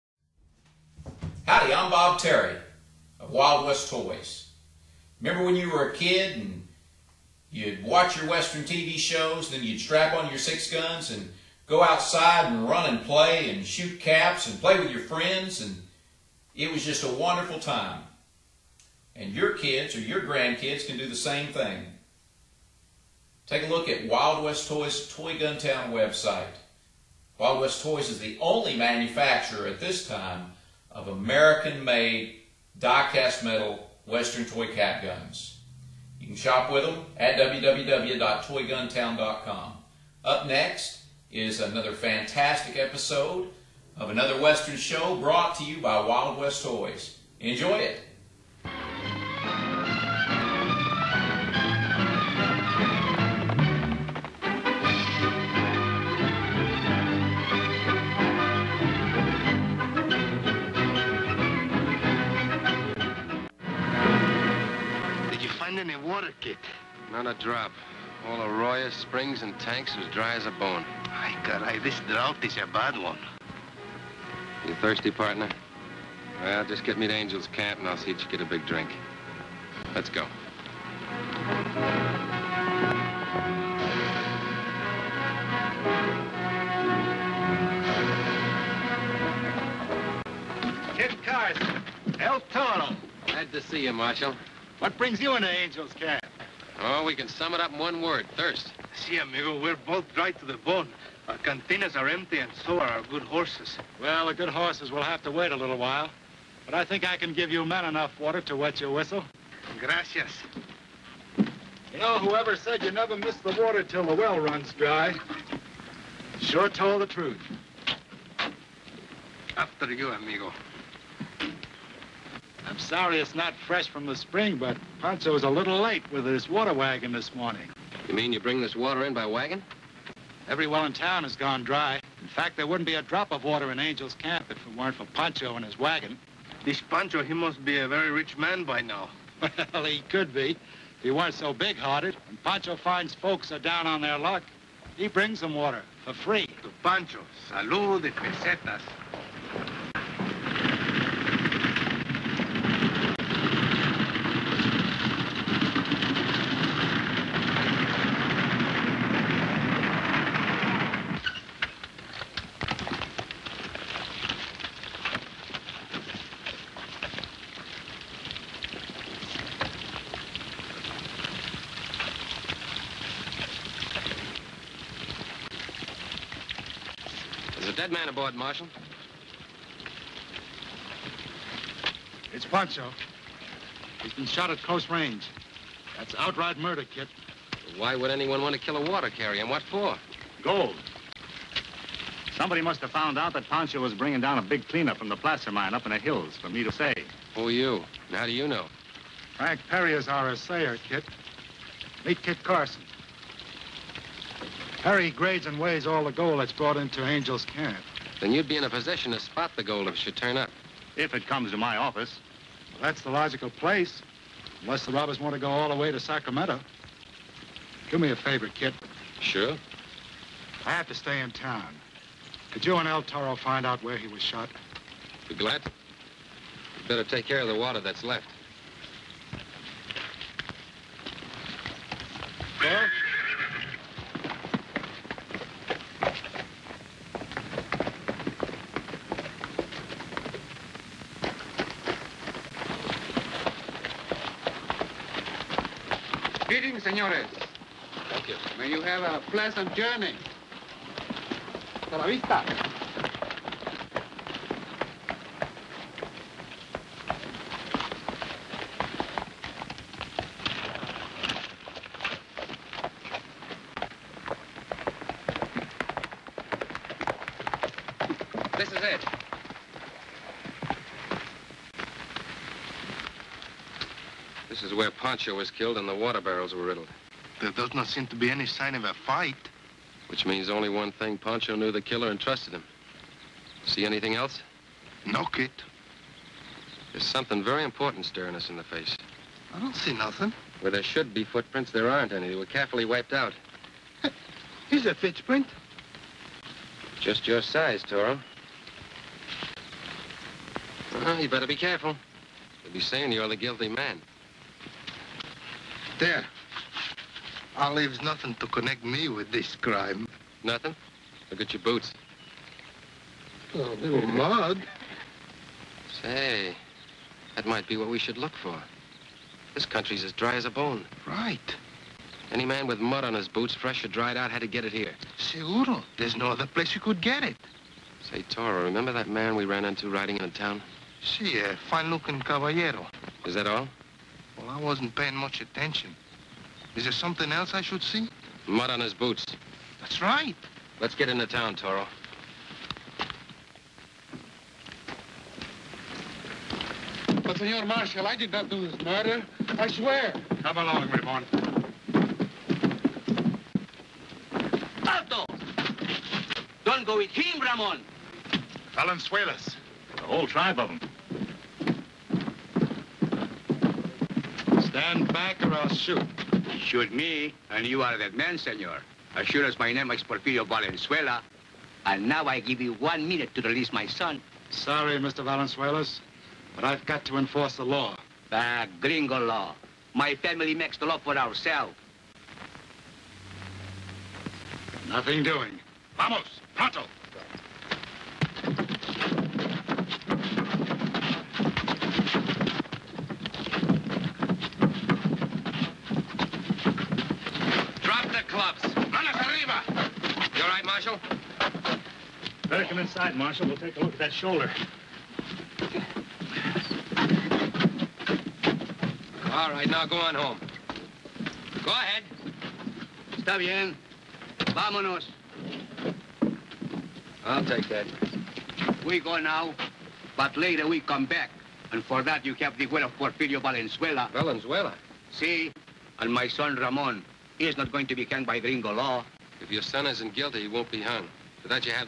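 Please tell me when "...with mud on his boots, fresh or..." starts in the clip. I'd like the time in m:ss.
5:22.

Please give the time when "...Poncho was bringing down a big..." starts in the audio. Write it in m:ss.
3:13.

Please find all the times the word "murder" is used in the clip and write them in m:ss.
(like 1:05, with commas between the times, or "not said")
3:06, 5:48.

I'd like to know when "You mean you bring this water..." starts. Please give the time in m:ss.
2:08.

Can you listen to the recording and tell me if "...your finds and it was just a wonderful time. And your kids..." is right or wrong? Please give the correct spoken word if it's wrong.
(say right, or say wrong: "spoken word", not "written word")
wrong: "friends", not "finds".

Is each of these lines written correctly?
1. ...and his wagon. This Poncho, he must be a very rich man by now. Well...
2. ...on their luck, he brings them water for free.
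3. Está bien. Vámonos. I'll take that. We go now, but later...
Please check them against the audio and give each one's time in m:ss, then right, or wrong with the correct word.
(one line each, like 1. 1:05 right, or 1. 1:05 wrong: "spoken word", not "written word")
1. 2:15 right
2. 2:23 right
3. 6:53 right.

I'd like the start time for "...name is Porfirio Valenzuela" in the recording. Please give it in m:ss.
6:09.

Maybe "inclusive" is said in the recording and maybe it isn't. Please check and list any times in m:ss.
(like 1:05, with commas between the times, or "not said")
not said.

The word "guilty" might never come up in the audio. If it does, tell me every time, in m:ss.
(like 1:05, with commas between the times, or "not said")
5:03, 7:10.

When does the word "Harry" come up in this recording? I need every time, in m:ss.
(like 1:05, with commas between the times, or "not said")
3:24.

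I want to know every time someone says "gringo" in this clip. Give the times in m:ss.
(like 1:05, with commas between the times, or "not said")
6:18, 7:08.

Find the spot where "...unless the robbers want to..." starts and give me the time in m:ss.
3:34.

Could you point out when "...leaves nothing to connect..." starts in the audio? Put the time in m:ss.
5:07.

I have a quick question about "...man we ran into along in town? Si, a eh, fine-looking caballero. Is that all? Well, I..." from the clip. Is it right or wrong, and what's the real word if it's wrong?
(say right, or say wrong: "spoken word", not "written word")
wrong: "riding", not "along".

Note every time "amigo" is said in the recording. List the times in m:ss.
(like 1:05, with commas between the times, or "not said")
1:39, 2:00.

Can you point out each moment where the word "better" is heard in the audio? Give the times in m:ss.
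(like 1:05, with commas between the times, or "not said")
3:46, 5:01.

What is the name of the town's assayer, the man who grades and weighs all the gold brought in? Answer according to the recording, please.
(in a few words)
Frank Perry.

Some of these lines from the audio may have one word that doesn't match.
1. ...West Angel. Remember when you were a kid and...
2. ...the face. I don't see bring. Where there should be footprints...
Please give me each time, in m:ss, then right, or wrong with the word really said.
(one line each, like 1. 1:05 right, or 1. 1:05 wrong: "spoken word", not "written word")
1. 0:03 wrong: "Toys", not "Angel"
2. 4:48 wrong: "nothing", not "bring".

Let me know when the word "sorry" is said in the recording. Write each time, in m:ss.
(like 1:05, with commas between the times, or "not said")
2:02, 6:14.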